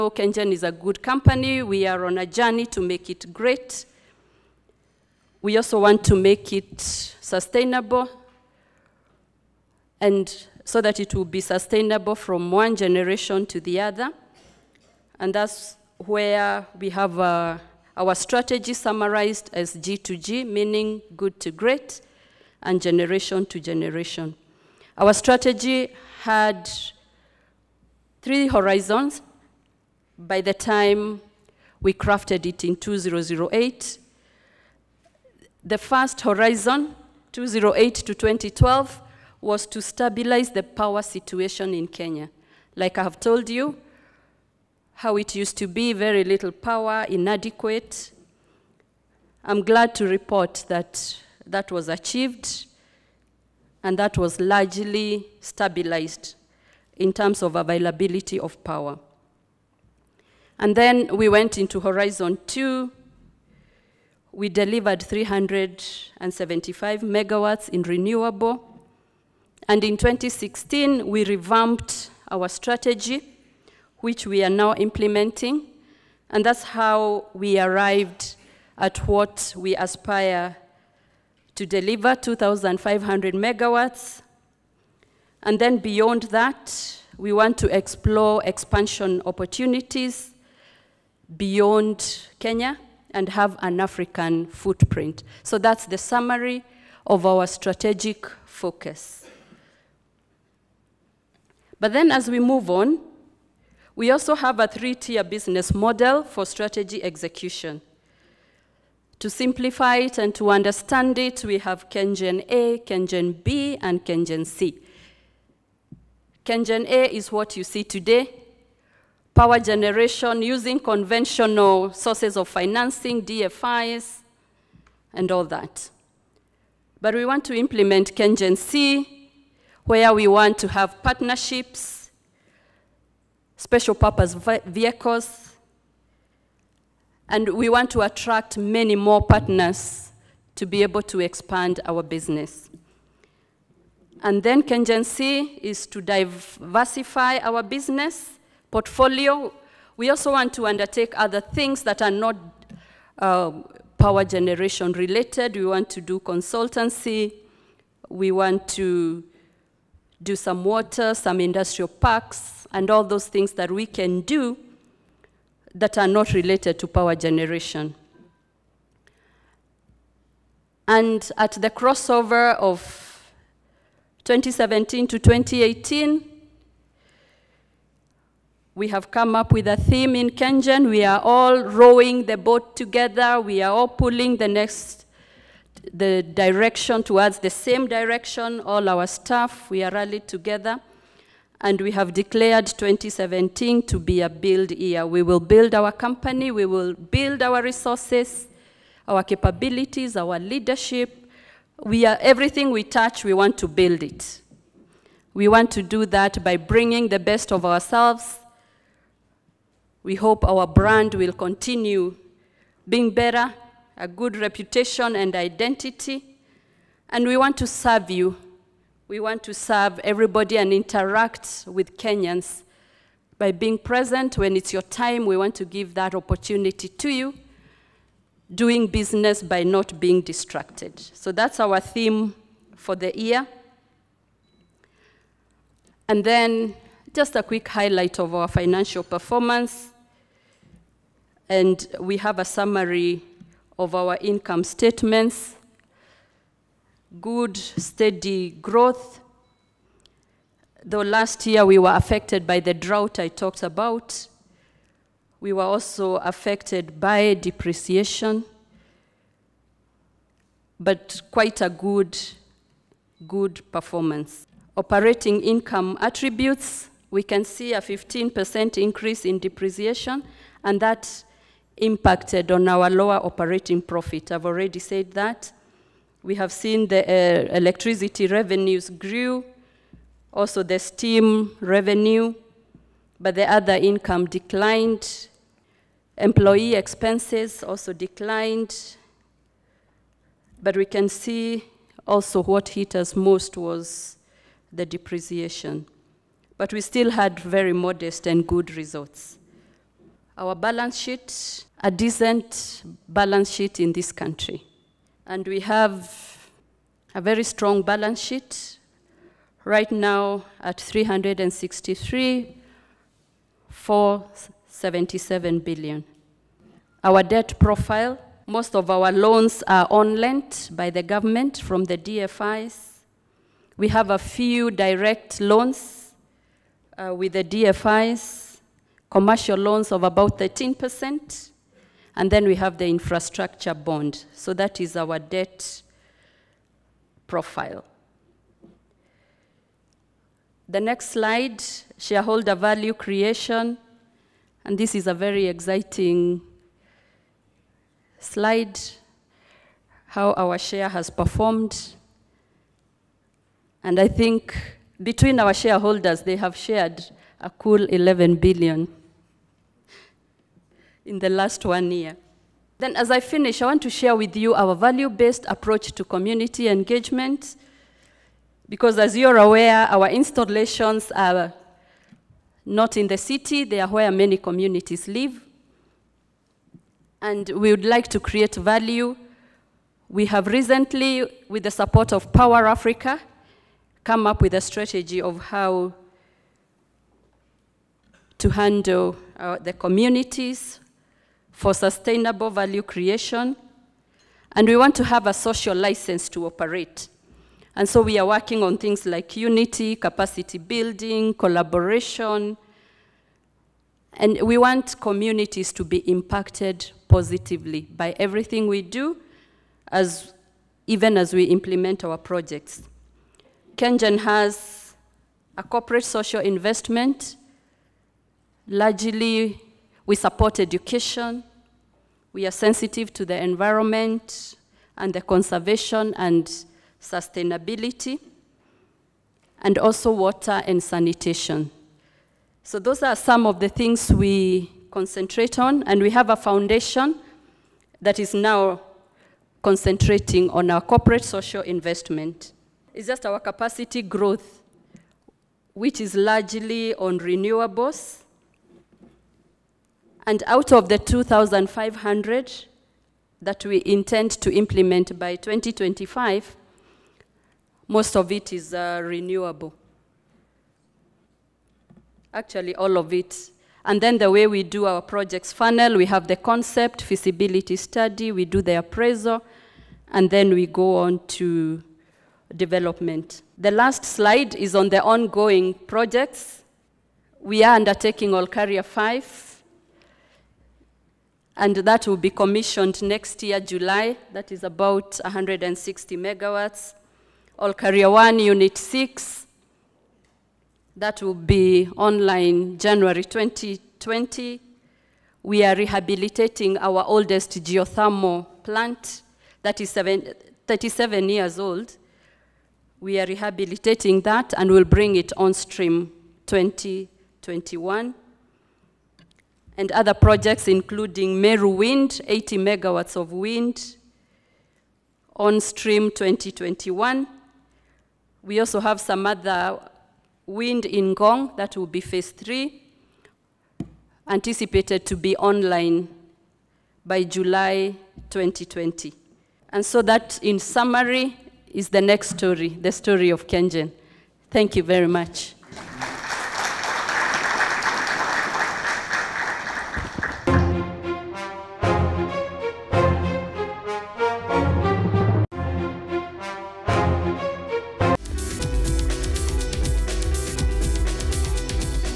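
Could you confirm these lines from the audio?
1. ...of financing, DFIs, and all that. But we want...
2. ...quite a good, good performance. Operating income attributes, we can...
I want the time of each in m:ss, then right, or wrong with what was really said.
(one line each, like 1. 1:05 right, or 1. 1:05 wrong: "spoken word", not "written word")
1. 2:02 right
2. 4:21 right.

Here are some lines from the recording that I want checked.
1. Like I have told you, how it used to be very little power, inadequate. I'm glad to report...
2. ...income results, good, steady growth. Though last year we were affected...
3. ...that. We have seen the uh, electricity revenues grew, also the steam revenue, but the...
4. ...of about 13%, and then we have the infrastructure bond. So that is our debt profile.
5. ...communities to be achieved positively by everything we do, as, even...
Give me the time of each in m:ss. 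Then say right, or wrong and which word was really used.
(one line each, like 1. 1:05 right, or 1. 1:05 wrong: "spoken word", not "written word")
1. 0:42 right
2. 4:04 wrong: "statements", not "results"
3. 4:35 right
4. 5:29 right
5. 6:44 wrong: "impacted", not "achieved".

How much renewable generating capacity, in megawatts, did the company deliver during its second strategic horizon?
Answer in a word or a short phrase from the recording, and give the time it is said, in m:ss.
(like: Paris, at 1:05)
375 megawatts, at 1:05.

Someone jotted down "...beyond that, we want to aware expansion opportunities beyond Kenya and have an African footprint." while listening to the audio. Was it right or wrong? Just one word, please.
wrong.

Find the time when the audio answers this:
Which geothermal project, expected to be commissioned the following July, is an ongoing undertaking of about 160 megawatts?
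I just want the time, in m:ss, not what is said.
7:58.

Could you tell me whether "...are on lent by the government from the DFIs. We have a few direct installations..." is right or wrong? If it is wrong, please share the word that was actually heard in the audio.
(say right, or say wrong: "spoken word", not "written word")
wrong: "loans", not "installations".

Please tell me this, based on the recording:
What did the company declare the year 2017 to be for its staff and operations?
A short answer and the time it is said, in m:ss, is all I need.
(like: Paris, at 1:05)
A build year, at 3:14.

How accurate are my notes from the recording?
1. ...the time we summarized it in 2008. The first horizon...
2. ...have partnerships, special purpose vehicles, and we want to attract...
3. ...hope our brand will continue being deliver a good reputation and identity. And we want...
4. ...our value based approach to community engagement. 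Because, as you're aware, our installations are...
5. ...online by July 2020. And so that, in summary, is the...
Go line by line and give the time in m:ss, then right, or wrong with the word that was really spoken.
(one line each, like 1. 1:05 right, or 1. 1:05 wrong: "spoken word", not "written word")
1. 0:30 wrong: "crafted", not "summarized"
2. 2:10 right
3. 3:30 wrong: "better", not "deliver"
4. 6:04 right
5. 8:45 right.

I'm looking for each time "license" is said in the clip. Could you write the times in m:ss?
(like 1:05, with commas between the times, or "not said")
6:35.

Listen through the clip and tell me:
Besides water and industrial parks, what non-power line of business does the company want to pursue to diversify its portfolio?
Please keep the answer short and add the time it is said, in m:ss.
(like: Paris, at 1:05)
Consultancy, at 2:36.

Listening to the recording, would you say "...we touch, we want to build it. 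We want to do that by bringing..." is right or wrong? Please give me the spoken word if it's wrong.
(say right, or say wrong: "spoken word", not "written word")
right.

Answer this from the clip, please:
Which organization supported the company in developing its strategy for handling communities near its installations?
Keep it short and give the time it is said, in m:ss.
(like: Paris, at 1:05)
Power Africa, at 6:22.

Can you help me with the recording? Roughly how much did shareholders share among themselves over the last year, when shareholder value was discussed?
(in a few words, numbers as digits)
11 billion.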